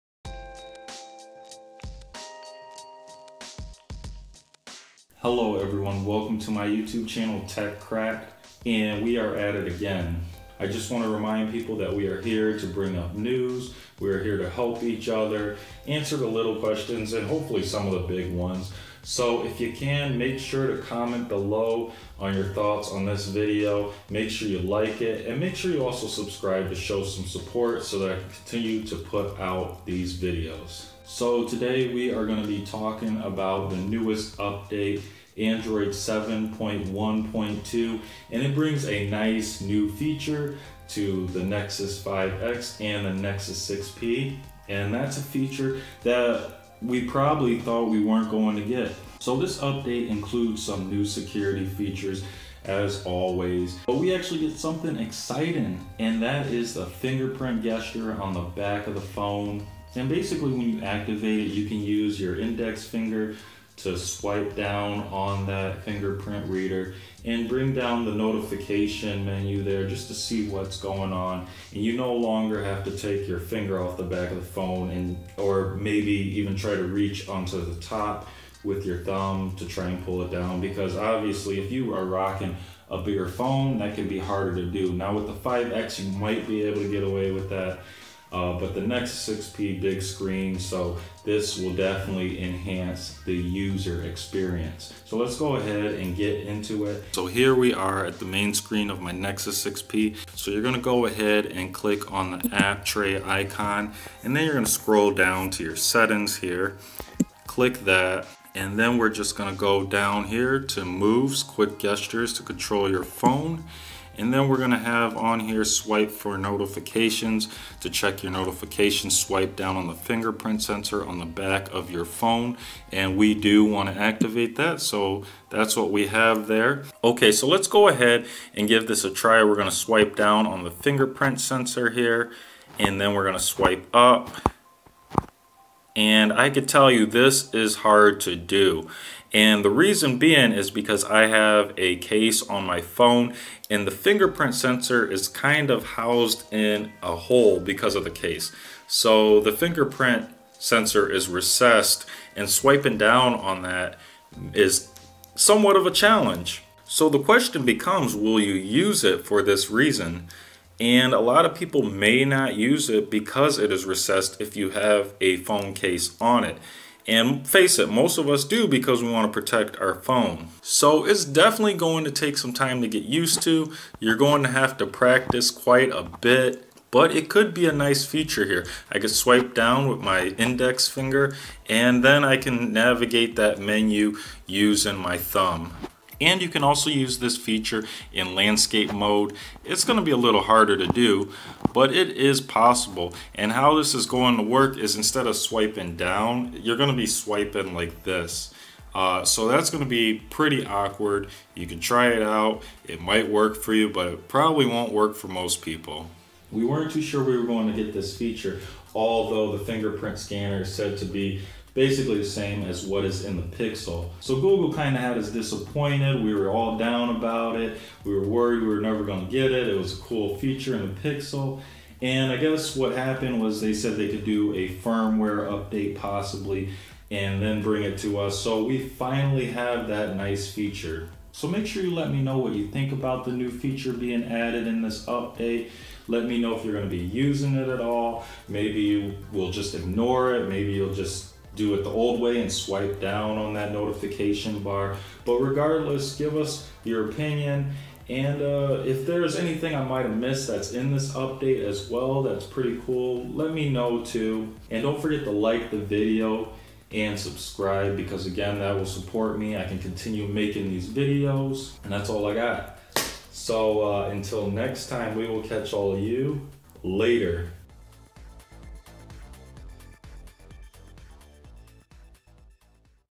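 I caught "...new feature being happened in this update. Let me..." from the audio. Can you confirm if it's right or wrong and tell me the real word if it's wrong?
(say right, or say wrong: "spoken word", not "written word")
wrong: "added", not "happened".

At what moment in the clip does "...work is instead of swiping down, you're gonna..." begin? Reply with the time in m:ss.
3:14.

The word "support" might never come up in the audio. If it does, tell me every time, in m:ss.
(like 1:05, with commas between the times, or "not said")
0:27, 4:18.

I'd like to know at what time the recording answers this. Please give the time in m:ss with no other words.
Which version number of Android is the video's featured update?
0:35.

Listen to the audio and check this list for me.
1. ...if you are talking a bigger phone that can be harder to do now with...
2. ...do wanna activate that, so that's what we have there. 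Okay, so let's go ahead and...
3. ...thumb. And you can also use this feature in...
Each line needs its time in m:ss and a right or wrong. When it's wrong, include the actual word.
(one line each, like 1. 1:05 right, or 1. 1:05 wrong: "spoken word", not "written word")
1. 1:21 wrong: "rocking", not "talking"
2. 2:03 right
3. 3:05 right.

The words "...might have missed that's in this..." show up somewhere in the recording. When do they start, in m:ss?
4:09.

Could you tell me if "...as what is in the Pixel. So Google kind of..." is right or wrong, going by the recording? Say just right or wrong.
right.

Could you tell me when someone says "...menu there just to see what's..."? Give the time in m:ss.
1:09.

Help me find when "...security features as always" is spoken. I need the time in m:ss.
0:51.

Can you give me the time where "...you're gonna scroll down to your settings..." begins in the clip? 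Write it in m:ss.
1:44.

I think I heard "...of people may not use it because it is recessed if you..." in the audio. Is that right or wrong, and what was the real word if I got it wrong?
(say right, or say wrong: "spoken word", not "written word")
right.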